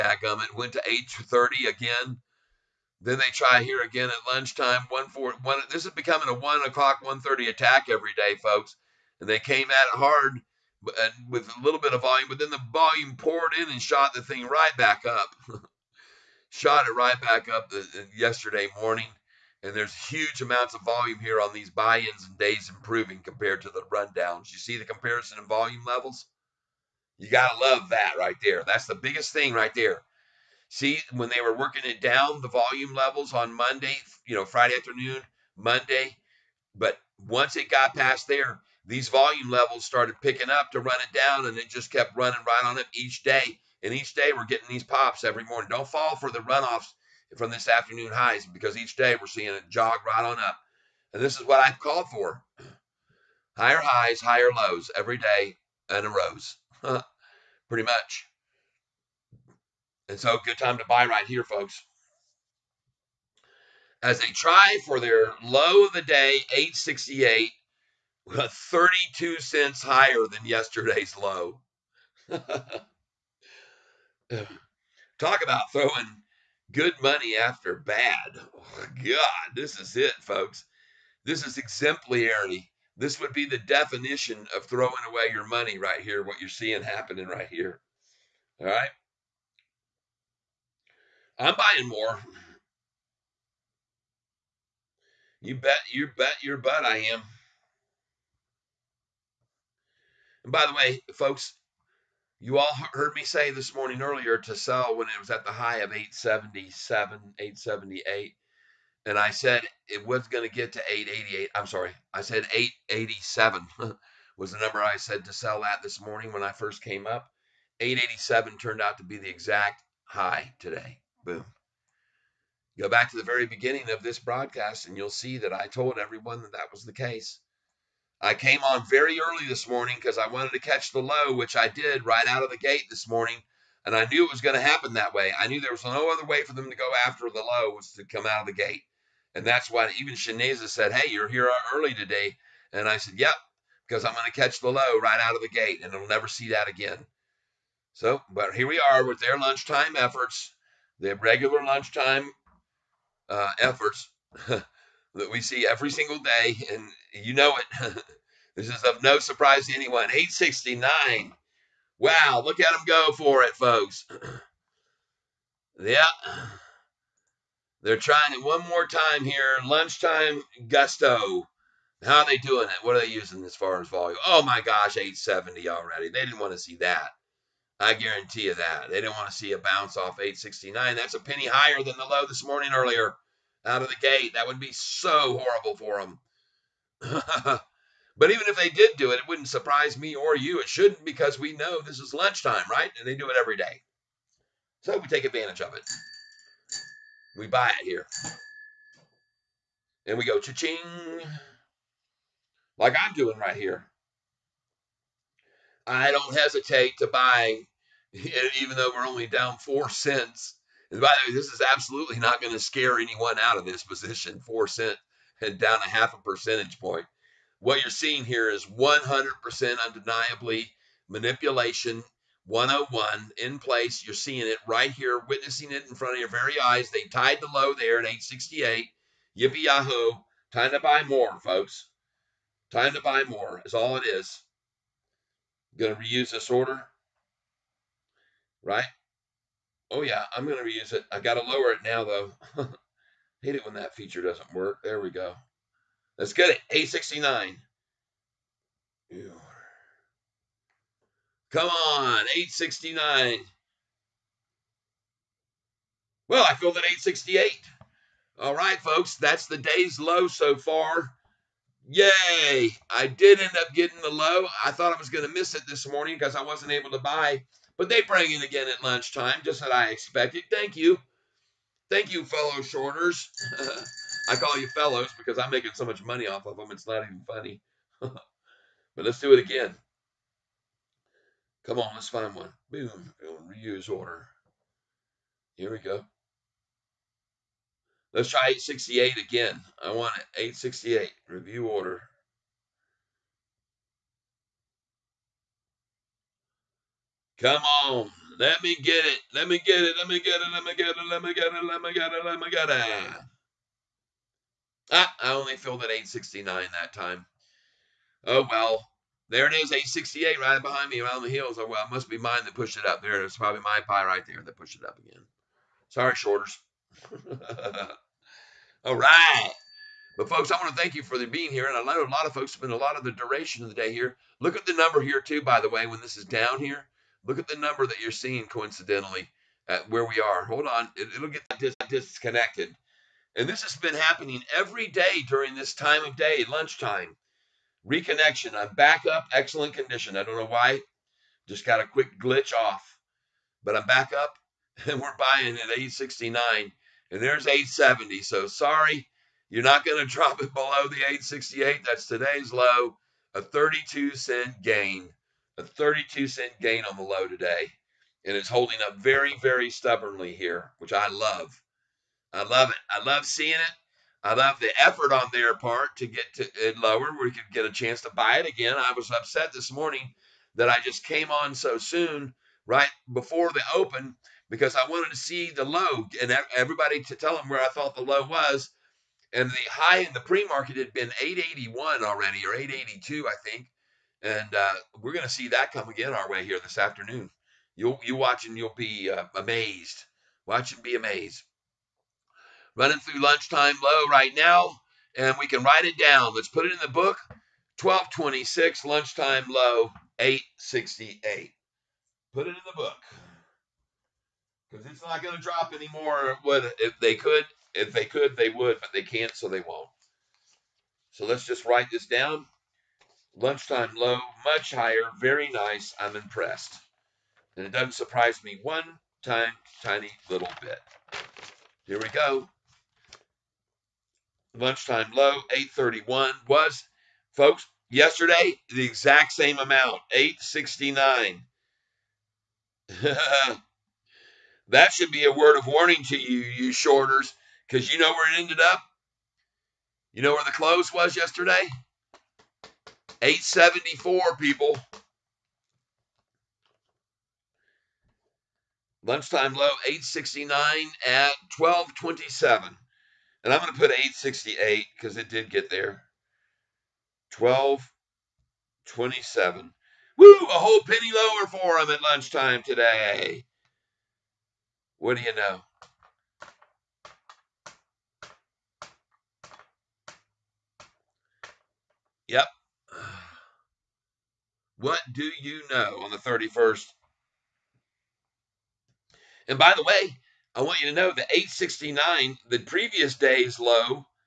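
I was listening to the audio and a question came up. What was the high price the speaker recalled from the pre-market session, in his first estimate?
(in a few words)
881.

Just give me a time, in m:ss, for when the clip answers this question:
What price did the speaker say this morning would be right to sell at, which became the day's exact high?
1:57.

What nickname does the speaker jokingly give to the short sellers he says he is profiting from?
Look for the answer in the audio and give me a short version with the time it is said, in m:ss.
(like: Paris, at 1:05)
fellow shorters, at 4:32.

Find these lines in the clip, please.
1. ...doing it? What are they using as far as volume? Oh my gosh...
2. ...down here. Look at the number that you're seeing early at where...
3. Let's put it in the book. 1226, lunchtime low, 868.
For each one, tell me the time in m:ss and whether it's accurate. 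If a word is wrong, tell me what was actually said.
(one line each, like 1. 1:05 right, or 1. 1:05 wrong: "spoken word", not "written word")
1. 2:52 right
2. 5:26 wrong: "coincidentally", not "early"
3. 6:36 right.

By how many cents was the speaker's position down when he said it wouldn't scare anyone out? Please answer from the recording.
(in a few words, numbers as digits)
4 cents.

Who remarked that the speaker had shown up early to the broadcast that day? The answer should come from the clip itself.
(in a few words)
Shaneza.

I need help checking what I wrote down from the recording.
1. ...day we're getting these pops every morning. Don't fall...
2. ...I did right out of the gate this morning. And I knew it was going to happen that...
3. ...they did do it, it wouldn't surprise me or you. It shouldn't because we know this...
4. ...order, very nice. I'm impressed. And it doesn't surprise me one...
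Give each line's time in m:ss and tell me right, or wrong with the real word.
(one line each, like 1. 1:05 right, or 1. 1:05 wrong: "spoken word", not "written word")
1. 0:44 right
2. 2:11 right
3. 3:08 right
4. 6:54 wrong: "higher", not "order".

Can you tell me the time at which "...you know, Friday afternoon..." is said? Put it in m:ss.
0:34.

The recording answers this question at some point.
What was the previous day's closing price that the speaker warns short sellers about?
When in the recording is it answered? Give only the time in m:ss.
7:23.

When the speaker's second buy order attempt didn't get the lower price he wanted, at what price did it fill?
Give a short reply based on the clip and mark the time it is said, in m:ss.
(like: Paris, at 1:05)
869, at 5:05.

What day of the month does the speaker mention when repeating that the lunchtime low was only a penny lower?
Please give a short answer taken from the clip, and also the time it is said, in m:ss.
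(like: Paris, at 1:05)
31st, at 7:56.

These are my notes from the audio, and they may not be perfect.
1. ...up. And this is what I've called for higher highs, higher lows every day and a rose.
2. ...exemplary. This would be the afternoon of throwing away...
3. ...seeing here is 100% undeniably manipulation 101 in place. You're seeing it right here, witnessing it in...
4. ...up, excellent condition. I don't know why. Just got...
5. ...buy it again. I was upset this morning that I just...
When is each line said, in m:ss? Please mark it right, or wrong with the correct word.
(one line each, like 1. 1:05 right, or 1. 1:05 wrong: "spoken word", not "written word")
1. 0:50 right
2. 1:21 wrong: "definition", not "afternoon"
3. 3:37 right
4. 5:39 right
5. 6:08 right.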